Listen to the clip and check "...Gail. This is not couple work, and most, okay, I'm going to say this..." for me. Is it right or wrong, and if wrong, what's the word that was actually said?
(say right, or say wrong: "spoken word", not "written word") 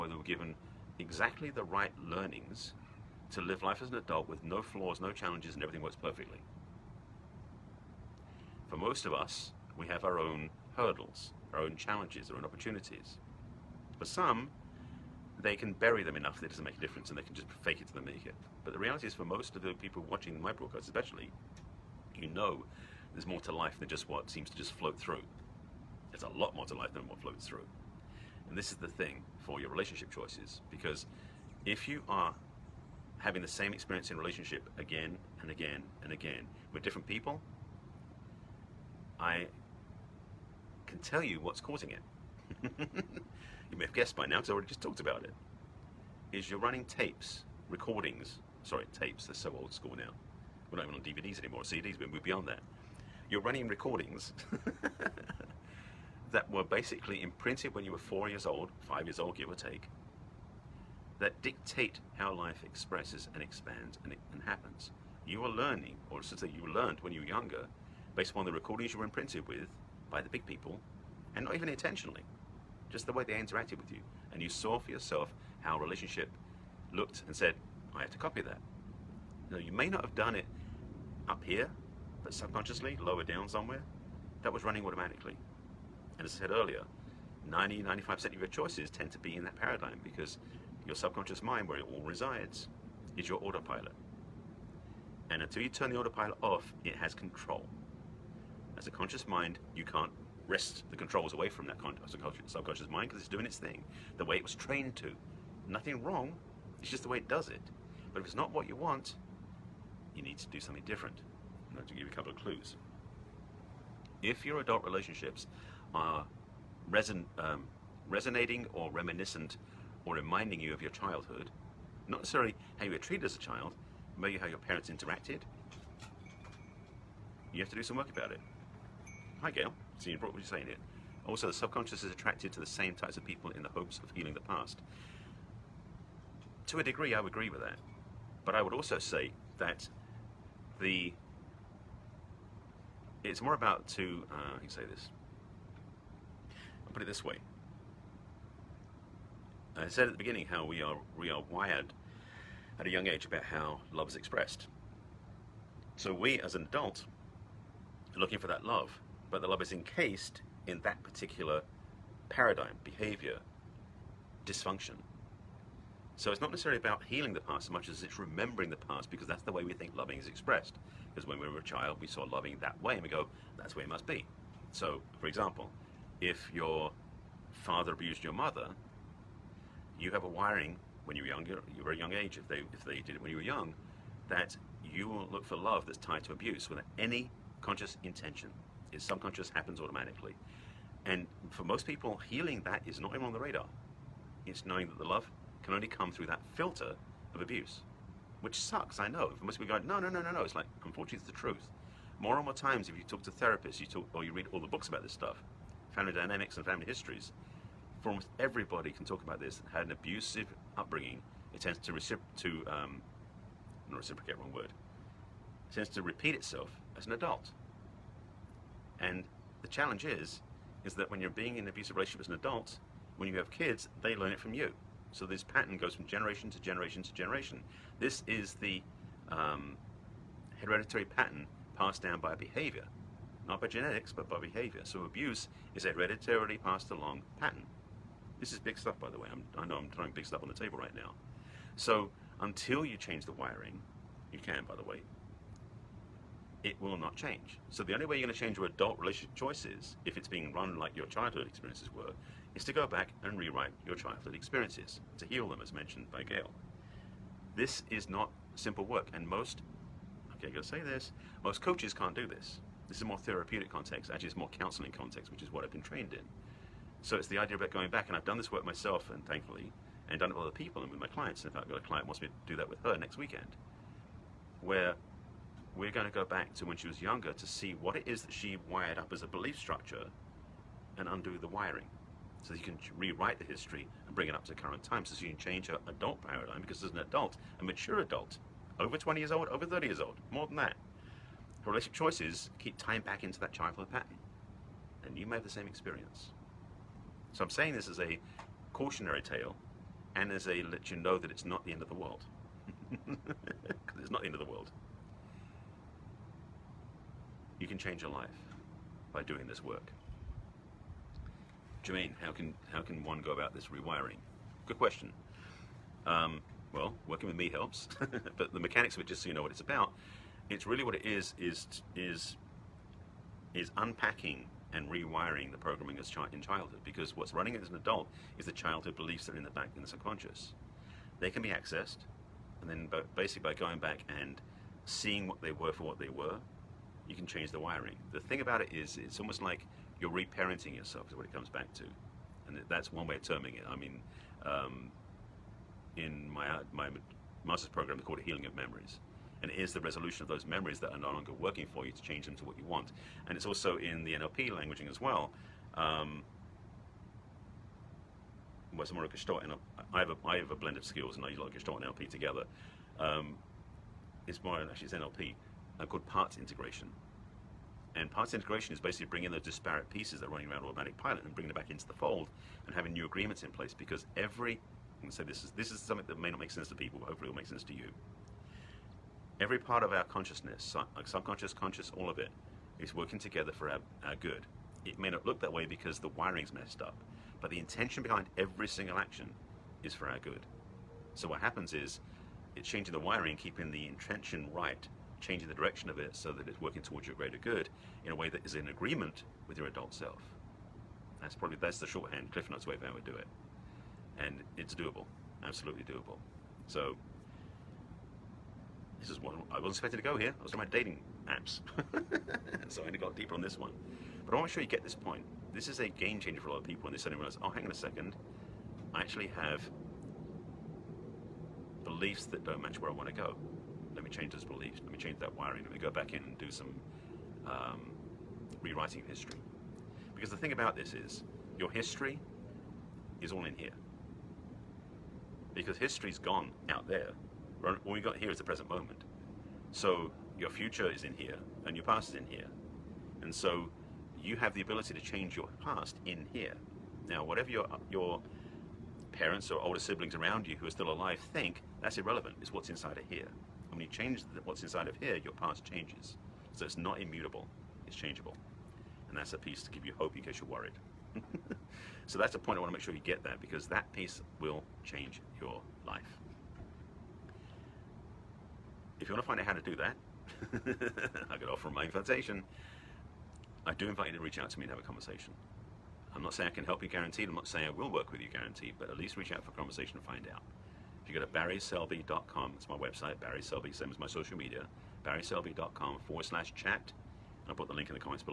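wrong: "simple", not "couple".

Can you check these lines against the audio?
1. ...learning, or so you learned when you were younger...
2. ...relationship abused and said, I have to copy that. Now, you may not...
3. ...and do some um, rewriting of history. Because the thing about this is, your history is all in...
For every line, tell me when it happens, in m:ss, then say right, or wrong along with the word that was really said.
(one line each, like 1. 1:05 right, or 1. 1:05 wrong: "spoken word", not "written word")
1. 1:05 right
2. 1:15 wrong: "looked", not "abused"
3. 7:06 right.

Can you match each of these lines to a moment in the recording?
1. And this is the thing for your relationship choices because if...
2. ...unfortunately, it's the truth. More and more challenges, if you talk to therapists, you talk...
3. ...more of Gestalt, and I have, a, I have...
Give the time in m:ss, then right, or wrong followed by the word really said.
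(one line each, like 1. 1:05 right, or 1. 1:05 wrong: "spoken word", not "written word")
1. 0:28 right
2. 3:20 wrong: "times", not "challenges"
3. 5:58 right.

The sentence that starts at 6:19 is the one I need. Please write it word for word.
Every part of our consciousness, like subconscious, conscious, all of it, is working together for our, our good.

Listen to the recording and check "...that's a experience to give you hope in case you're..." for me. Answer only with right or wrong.
wrong.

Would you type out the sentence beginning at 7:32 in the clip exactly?
It's what's inside of here when you change what's inside of here, your past changes.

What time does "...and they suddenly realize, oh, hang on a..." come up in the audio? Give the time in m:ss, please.
6:56.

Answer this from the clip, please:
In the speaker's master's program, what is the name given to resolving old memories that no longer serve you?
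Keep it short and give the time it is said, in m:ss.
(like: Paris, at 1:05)
Healing of Memories, at 5:48.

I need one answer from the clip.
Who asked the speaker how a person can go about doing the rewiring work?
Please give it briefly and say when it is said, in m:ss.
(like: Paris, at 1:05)
Jermaine, at 5:11.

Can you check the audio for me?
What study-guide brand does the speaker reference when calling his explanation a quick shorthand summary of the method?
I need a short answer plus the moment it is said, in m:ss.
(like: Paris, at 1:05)
Cliff Notes, at 6:42.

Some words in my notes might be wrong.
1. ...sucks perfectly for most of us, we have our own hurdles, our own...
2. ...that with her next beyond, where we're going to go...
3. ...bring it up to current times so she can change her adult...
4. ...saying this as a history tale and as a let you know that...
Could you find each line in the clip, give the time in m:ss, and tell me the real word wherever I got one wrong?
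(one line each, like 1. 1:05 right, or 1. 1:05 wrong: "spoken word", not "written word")
1. 0:05 wrong: "works", not "sucks"
2. 4:32 wrong: "weekend", not "beyond"
3. 4:44 right
4. 4:57 wrong: "cautionary", not "history".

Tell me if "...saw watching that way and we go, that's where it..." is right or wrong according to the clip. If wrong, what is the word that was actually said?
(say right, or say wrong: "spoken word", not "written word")
wrong: "loving", not "watching".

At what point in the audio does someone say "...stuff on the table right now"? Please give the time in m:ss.
4:00.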